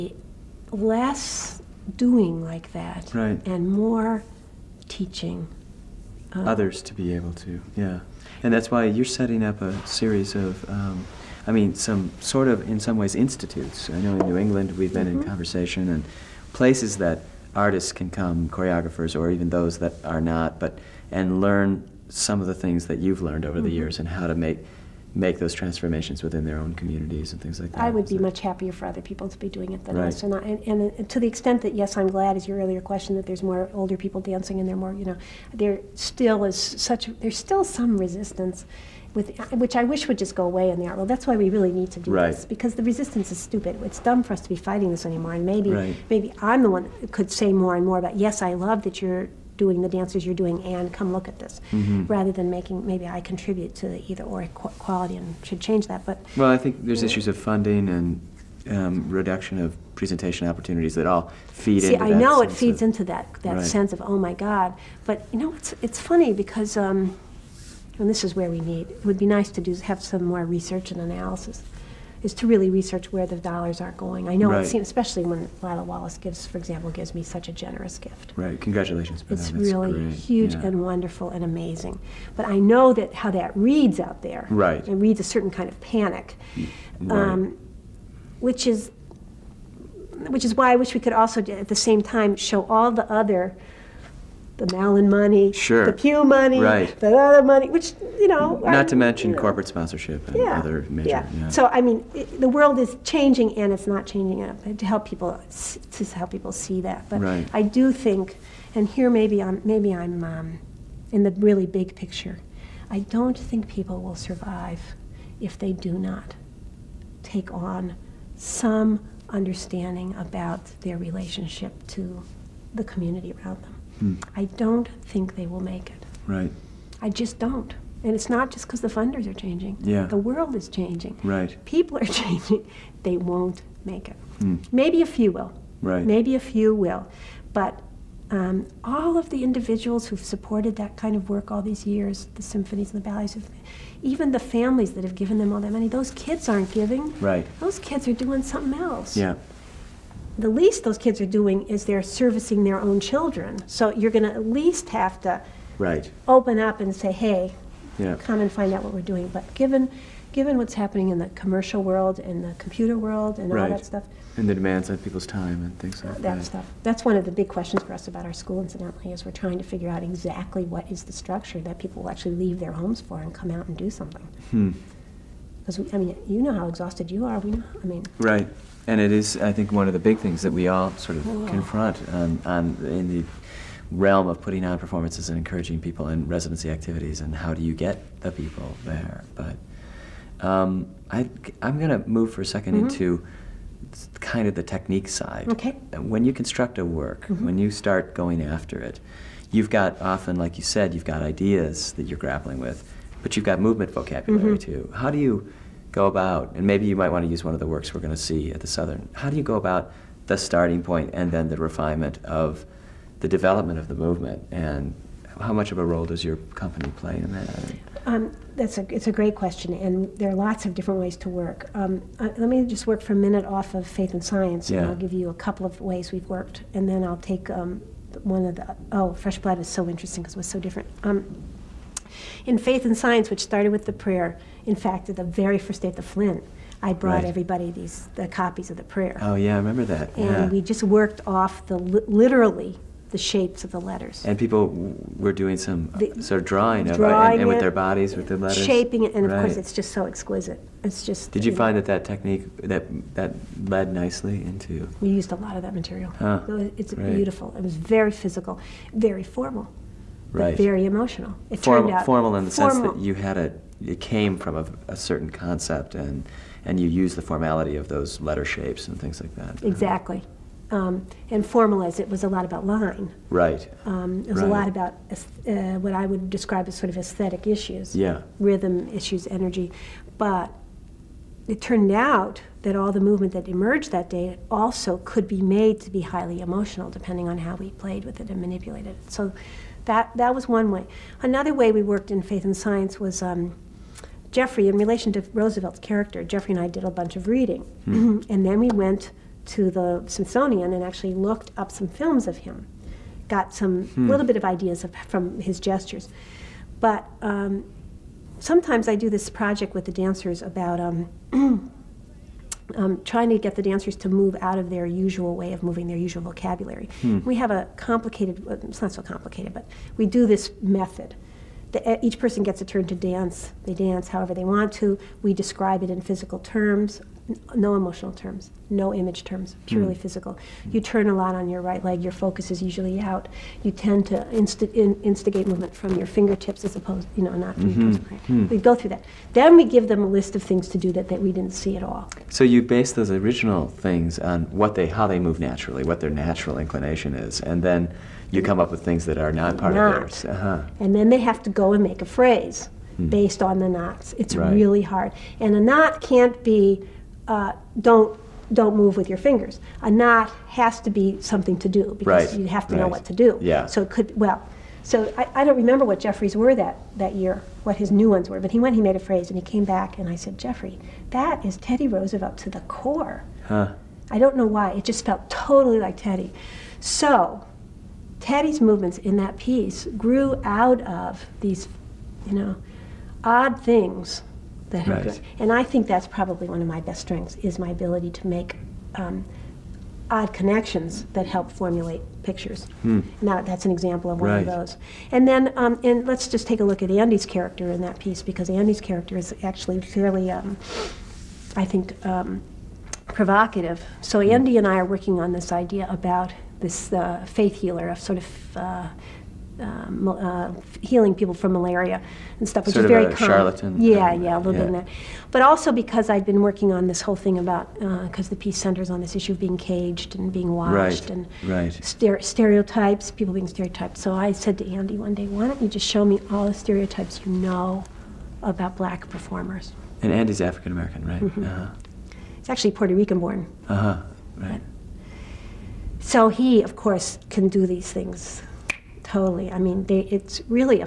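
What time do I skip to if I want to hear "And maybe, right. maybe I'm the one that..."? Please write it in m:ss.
0:45.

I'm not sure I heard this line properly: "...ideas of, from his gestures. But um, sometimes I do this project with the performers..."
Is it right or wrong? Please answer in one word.
wrong.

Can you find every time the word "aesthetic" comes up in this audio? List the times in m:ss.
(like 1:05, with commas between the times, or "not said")
4:36.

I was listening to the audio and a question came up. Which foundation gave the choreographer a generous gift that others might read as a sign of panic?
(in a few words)
Lila Wallace.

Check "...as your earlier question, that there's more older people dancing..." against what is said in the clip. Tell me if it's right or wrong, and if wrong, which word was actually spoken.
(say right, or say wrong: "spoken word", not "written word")
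right.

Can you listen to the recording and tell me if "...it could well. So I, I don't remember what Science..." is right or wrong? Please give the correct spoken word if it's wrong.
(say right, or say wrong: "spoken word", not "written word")
wrong: "Jeffries", not "Science".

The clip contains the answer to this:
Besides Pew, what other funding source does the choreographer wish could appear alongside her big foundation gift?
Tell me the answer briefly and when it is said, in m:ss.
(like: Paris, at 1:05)
Mellon, at 1:34.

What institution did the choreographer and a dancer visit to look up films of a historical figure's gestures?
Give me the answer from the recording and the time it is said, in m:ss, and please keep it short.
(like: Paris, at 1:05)
the Smithsonian, at 5:00.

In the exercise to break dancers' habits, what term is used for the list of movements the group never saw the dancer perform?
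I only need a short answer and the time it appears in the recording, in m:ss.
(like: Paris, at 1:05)
knots, at 5:53.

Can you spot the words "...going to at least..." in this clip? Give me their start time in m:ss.
2:34.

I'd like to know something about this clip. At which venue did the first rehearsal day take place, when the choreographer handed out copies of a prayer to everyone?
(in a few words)
the Flynn.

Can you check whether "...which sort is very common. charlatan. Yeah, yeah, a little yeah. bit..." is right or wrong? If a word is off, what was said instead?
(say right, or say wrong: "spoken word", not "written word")
right.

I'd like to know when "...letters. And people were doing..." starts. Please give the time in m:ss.
4:03.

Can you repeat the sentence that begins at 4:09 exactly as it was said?
of course, it's just so exquisite.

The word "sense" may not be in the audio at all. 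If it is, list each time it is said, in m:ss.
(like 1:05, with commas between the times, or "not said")
1:03, 4:22.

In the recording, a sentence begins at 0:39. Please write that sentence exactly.
With, which I wish would just go away in the art world.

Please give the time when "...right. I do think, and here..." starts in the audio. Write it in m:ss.
1:47.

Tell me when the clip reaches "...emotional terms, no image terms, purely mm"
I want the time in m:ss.
5:27.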